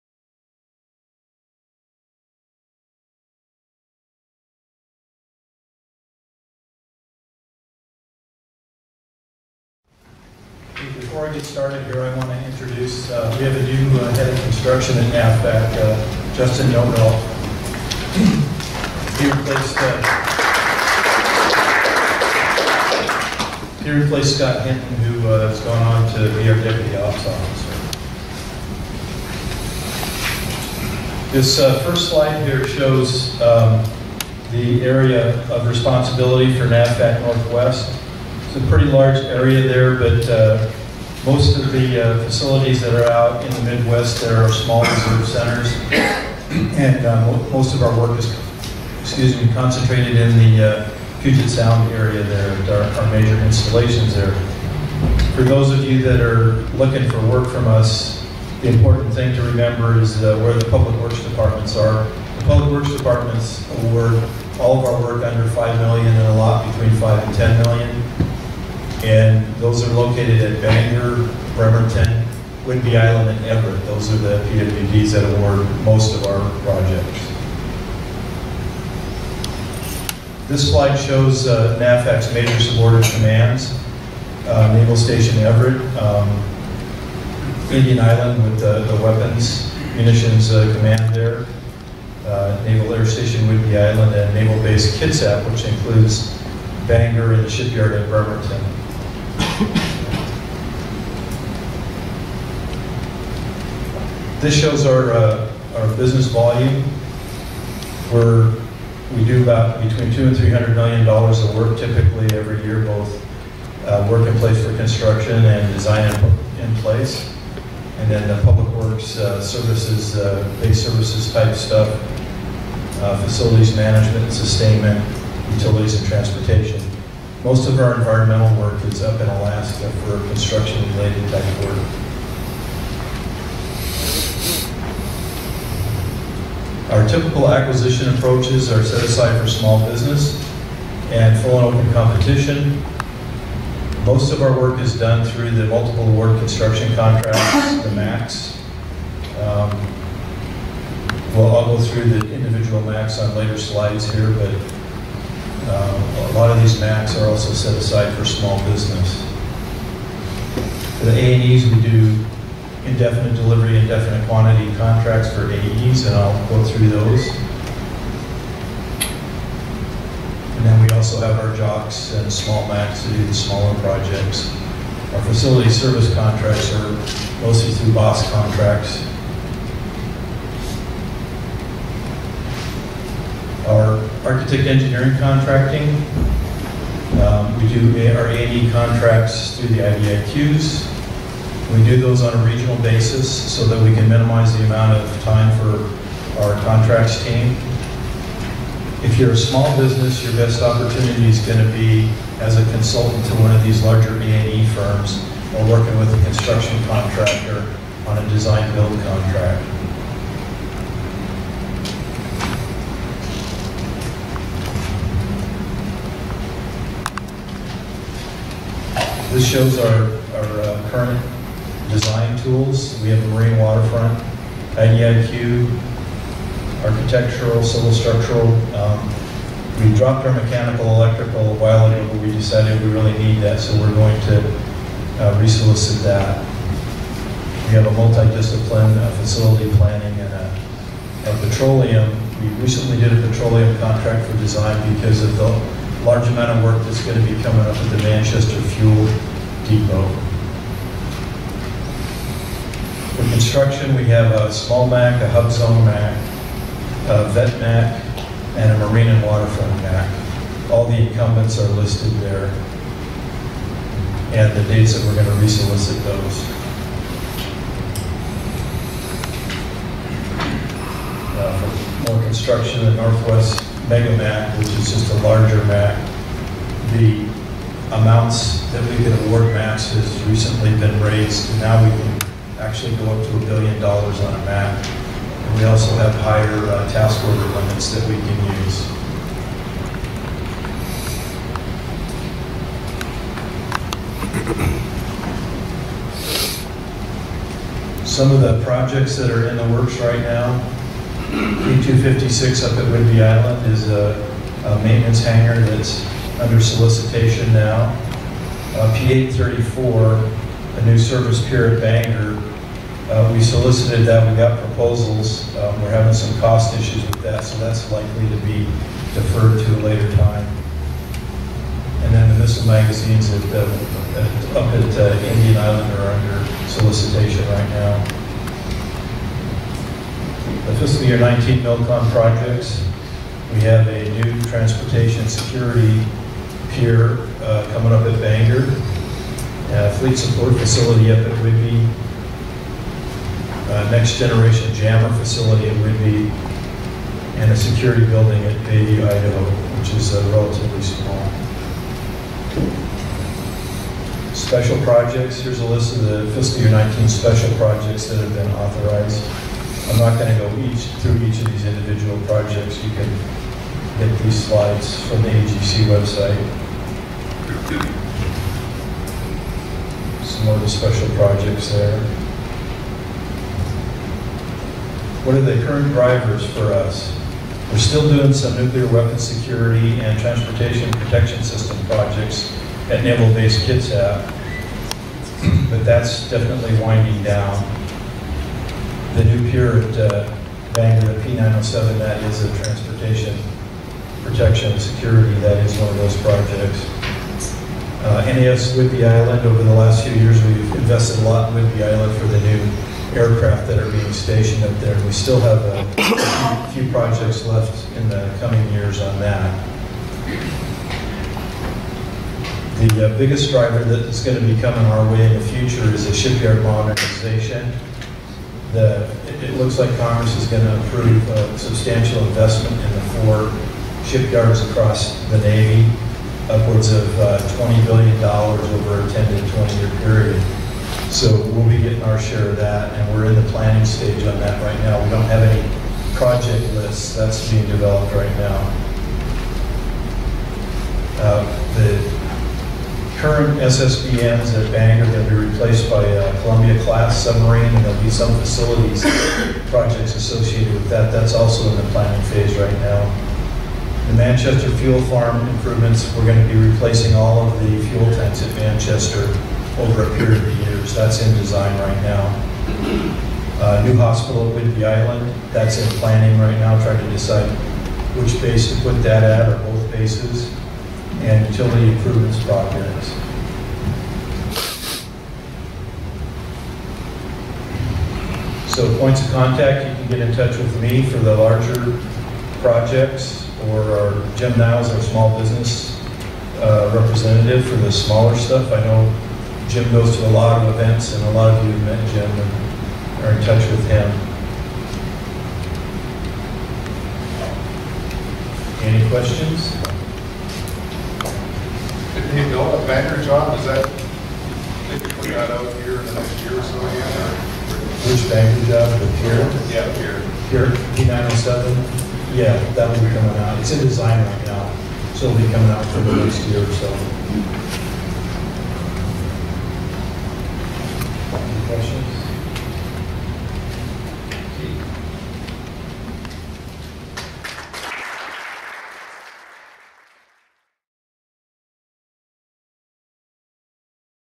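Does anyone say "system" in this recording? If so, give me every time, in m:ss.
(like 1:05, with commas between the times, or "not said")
6:21.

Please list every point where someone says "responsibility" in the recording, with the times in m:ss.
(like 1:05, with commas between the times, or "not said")
0:35.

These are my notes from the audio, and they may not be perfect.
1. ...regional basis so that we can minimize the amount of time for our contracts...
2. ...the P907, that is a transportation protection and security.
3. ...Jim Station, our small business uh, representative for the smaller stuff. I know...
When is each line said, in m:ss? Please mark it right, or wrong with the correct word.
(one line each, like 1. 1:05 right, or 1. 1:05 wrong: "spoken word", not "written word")
1. 3:12 right
2. 6:31 right
3. 8:04 wrong: "Niles", not "Station".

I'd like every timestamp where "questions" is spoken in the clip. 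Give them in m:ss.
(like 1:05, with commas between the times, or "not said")
8:19.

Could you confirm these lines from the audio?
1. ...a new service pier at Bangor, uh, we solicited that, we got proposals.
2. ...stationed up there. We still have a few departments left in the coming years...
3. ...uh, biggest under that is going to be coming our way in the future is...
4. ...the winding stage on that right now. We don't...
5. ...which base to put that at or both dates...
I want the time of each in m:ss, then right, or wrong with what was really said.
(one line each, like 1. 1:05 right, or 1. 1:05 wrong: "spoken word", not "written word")
1. 5:10 right
2. 6:44 wrong: "projects", not "departments"
3. 6:53 wrong: "driver", not "under"
4. 7:13 wrong: "planning", not "winding"
5. 7:48 wrong: "bases", not "dates".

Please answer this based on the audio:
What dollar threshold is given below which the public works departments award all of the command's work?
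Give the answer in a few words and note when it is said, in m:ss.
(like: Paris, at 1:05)
5 million, at 1:05.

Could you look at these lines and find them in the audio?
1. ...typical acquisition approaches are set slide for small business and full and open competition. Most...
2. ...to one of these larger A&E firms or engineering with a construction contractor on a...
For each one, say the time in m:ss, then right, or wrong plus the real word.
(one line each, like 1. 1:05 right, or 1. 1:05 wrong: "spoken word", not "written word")
1. 2:17 wrong: "aside", not "slide"
2. 3:23 wrong: "working", not "engineering".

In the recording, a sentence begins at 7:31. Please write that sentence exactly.
That's also in the planning phase right now.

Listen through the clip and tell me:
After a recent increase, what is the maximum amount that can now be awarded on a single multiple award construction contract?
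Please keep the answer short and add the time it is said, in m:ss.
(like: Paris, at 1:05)
1 billion dollars, at 4:43.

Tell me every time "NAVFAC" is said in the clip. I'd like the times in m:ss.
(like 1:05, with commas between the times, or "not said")
0:15, 0:36, 1:21.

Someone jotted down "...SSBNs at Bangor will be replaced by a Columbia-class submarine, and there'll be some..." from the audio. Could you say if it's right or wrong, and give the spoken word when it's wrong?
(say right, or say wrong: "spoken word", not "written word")
right.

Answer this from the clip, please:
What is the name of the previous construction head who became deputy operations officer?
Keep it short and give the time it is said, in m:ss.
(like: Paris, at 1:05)
Scott Hinton, at 0:24.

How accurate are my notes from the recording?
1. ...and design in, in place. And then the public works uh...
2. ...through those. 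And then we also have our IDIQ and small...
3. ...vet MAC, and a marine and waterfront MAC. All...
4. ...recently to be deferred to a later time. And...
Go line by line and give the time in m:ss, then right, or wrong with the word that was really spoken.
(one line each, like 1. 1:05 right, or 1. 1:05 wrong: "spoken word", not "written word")
1. 1:55 right
2. 2:46 wrong: "JOCs", not "IDIQ"
3. 4:17 right
4. 5:17 wrong: "likely", not "recently".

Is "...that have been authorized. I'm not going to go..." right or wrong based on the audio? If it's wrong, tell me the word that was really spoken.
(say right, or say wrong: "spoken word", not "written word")
right.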